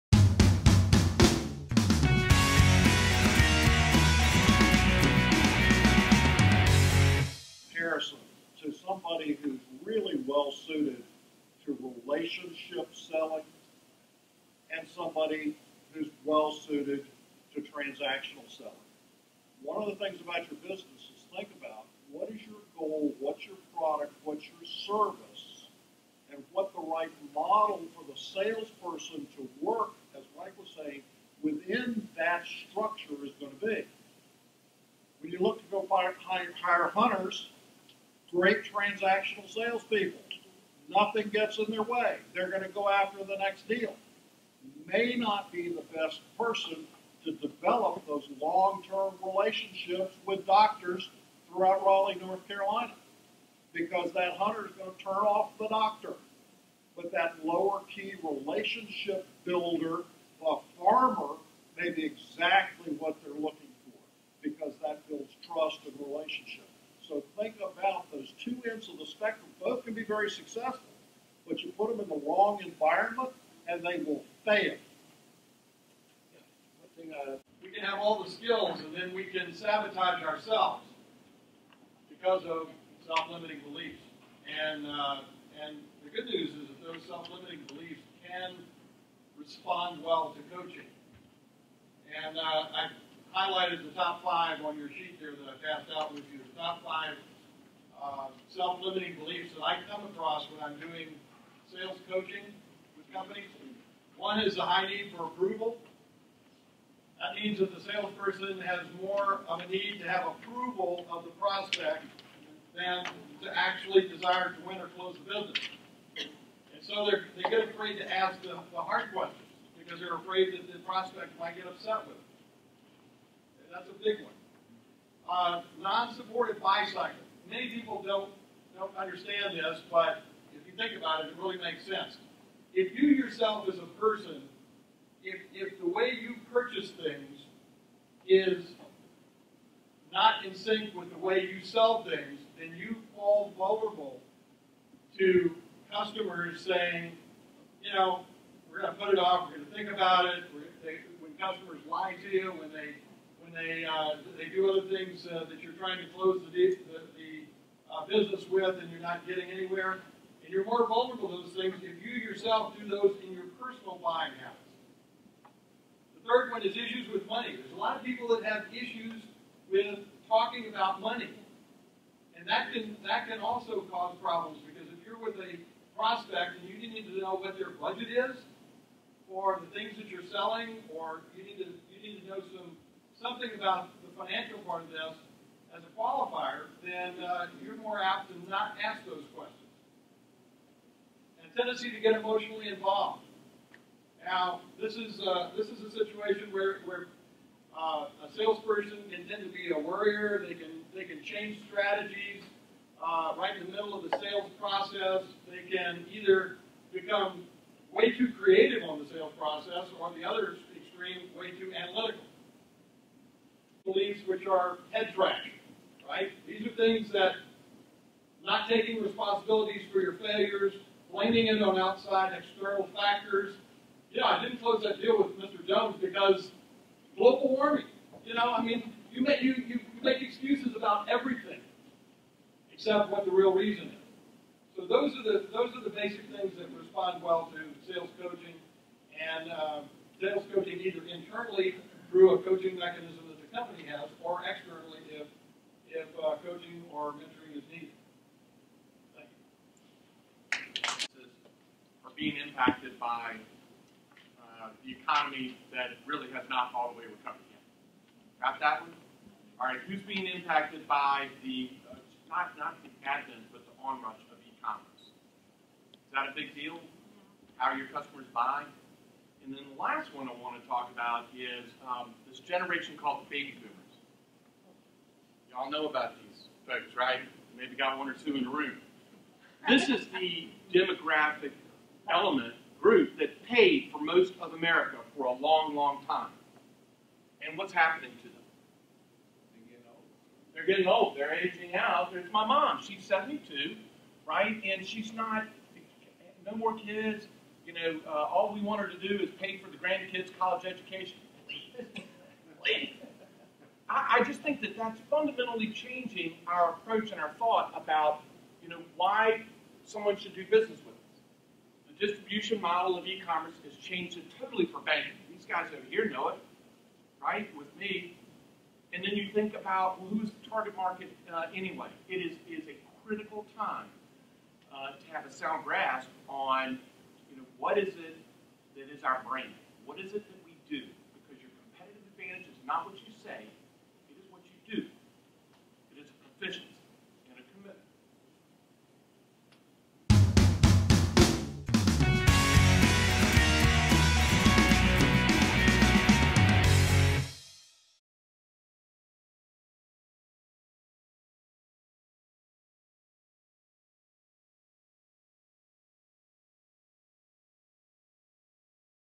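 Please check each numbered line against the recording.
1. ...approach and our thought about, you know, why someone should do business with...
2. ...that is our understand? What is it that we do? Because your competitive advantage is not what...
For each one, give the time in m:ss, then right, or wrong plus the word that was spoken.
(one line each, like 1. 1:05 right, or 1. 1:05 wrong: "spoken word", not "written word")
1. 5:06 right
2. 5:28 wrong: "brand", not "understand".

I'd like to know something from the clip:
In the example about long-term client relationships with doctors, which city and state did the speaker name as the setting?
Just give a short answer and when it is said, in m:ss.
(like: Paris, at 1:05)
Raleigh, North Carolina, at 0:51.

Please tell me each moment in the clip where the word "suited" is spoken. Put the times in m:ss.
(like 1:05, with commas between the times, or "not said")
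0:10, 0:16.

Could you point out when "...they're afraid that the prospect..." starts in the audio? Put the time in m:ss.
1:59.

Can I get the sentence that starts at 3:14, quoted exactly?
Now, this is uh, this is a situation where, where uh, a salesperson can tend to be a worrier.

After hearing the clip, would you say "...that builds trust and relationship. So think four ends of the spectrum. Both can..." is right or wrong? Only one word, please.
wrong.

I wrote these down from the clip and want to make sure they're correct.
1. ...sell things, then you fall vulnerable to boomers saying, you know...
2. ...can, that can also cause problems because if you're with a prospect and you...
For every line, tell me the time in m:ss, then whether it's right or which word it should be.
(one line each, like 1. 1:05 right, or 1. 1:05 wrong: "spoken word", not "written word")
1. 2:21 wrong: "customers", not "boomers"
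2. 2:52 right.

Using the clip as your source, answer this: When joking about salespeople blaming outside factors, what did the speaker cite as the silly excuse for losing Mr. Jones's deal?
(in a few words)
global warming.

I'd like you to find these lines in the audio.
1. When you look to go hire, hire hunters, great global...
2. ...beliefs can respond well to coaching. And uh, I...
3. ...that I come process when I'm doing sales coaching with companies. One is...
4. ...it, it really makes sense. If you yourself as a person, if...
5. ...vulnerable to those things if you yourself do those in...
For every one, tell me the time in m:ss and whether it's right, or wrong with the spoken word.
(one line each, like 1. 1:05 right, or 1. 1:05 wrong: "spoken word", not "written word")
1. 0:35 wrong: "transactional", not "global"
2. 1:27 right
3. 1:39 wrong: "across", not "process"
4. 2:11 right
5. 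2:40 right.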